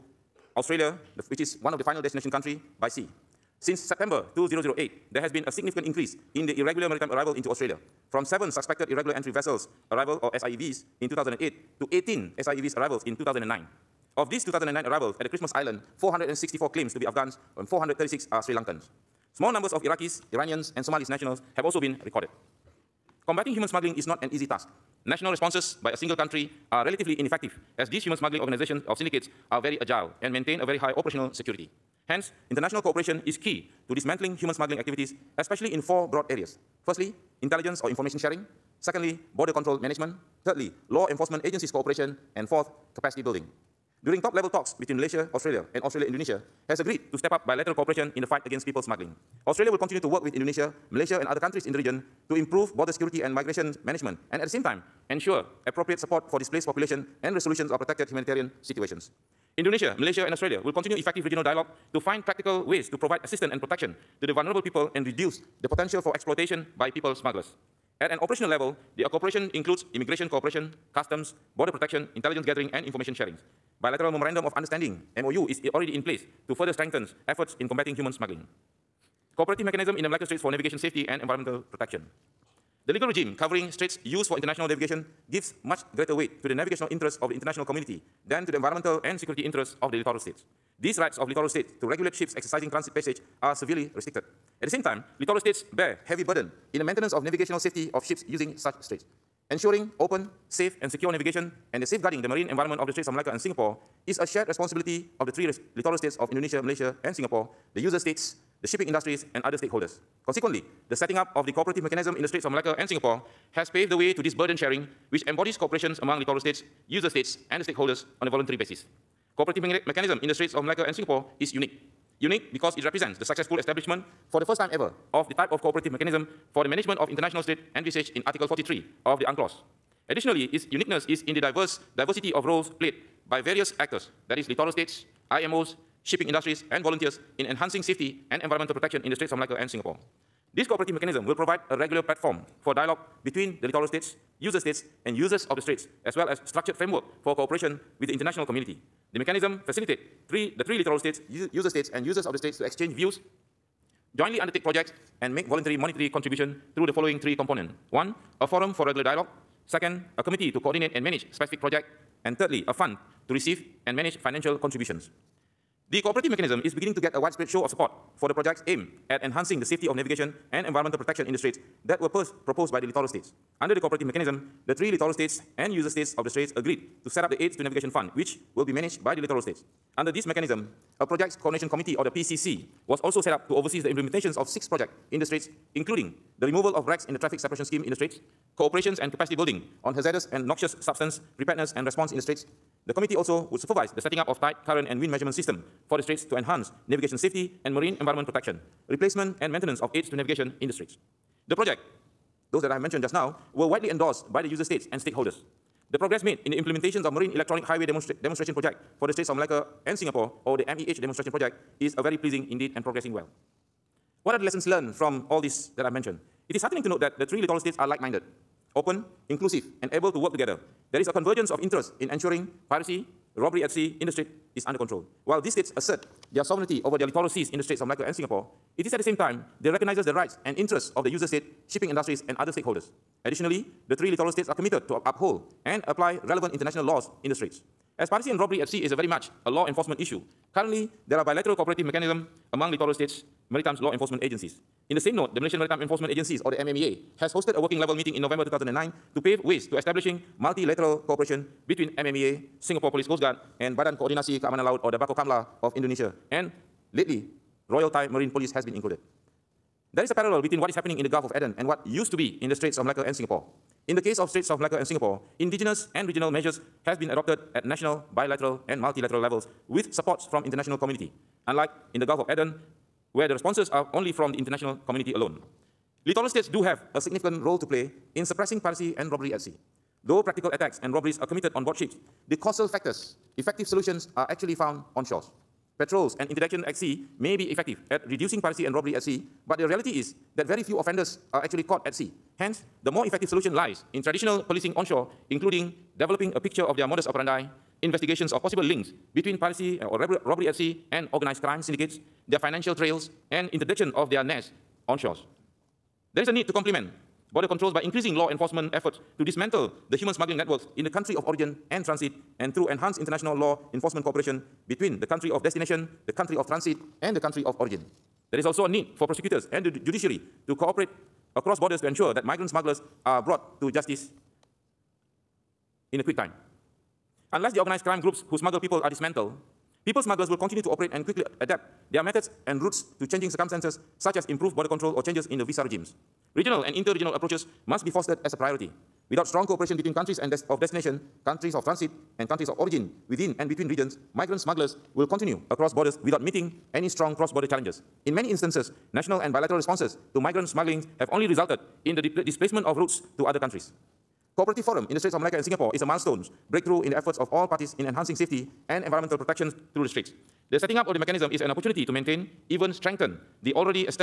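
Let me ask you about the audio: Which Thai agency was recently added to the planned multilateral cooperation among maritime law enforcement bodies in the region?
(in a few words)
Royal Thai Marine Police.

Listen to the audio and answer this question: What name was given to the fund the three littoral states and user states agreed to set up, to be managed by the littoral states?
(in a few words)
Aid to Navigation Fund.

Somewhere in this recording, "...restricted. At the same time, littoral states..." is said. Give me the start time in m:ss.
1:33.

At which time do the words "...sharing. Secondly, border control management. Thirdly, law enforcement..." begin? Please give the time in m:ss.
0:38.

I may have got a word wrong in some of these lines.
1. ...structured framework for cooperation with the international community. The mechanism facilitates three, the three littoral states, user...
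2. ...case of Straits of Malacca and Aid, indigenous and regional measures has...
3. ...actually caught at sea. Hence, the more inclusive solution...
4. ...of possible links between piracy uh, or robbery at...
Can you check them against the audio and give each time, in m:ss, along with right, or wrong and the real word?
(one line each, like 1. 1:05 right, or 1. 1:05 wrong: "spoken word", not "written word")
1. 2:26 right
2. 4:24 wrong: "Singapore", not "Aid"
3. 4:51 wrong: "effective", not "inclusive"
4. 4:58 right.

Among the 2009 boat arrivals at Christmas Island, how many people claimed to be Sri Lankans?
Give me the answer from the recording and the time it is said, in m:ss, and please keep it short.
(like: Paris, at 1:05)
436, at 0:17.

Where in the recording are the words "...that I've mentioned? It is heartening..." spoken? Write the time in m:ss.
3:35.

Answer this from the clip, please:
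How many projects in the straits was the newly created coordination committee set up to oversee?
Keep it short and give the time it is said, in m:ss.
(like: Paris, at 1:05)
6, at 3:04.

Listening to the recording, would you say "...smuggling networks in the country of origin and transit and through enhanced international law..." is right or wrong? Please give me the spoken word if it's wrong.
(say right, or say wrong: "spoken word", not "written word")
right.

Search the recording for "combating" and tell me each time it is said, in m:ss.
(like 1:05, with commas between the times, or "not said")
0:23, 1:17.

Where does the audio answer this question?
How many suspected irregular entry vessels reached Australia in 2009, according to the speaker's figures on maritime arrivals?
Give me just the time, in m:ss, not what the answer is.
0:11.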